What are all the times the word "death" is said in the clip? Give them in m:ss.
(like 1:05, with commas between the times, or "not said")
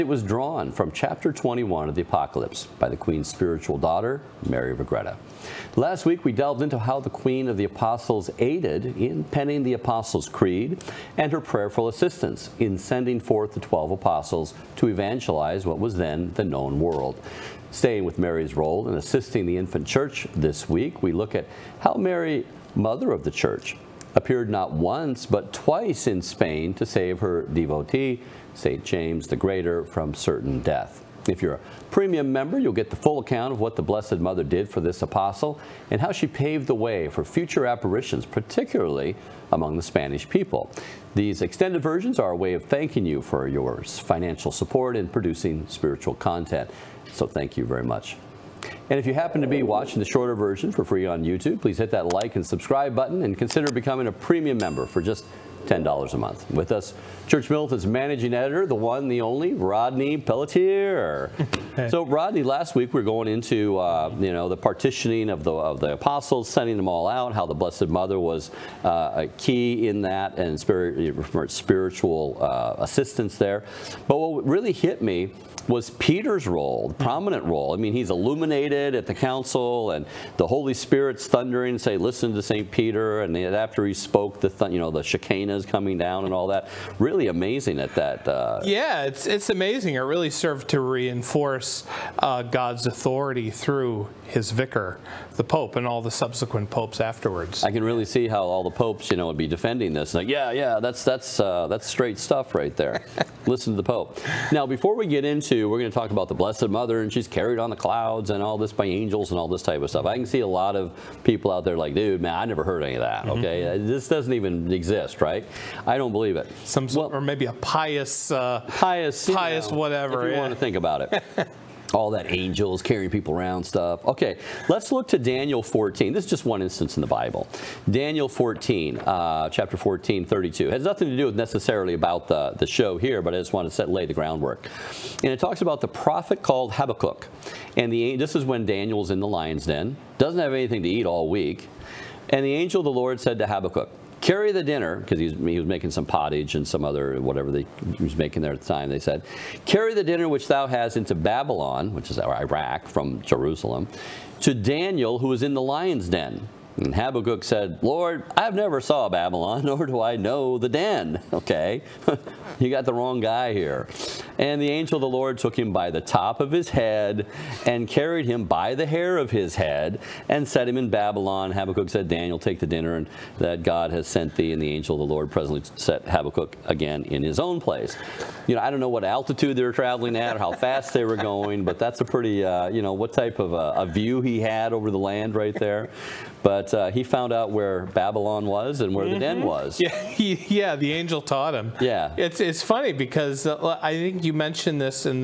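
0:30.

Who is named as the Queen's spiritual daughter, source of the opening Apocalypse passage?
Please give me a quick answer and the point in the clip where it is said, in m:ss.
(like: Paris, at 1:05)
Mary of Agreta, at 0:04.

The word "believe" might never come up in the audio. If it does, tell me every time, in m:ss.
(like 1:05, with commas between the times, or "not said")
1:56.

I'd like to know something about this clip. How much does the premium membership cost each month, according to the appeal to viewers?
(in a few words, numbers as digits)
$10.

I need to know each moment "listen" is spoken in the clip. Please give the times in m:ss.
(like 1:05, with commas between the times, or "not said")
1:21, 1:43.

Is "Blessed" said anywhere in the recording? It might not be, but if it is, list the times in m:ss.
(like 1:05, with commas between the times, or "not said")
0:33, 1:07, 1:46.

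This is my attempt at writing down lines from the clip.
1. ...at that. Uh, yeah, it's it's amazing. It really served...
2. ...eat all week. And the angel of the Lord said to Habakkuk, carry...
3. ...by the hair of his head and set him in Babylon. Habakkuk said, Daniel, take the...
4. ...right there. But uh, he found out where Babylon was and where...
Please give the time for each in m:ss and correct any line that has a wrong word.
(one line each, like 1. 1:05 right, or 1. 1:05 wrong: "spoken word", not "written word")
1. 1:27 right
2. 2:20 right
3. 2:48 right
4. 3:05 right.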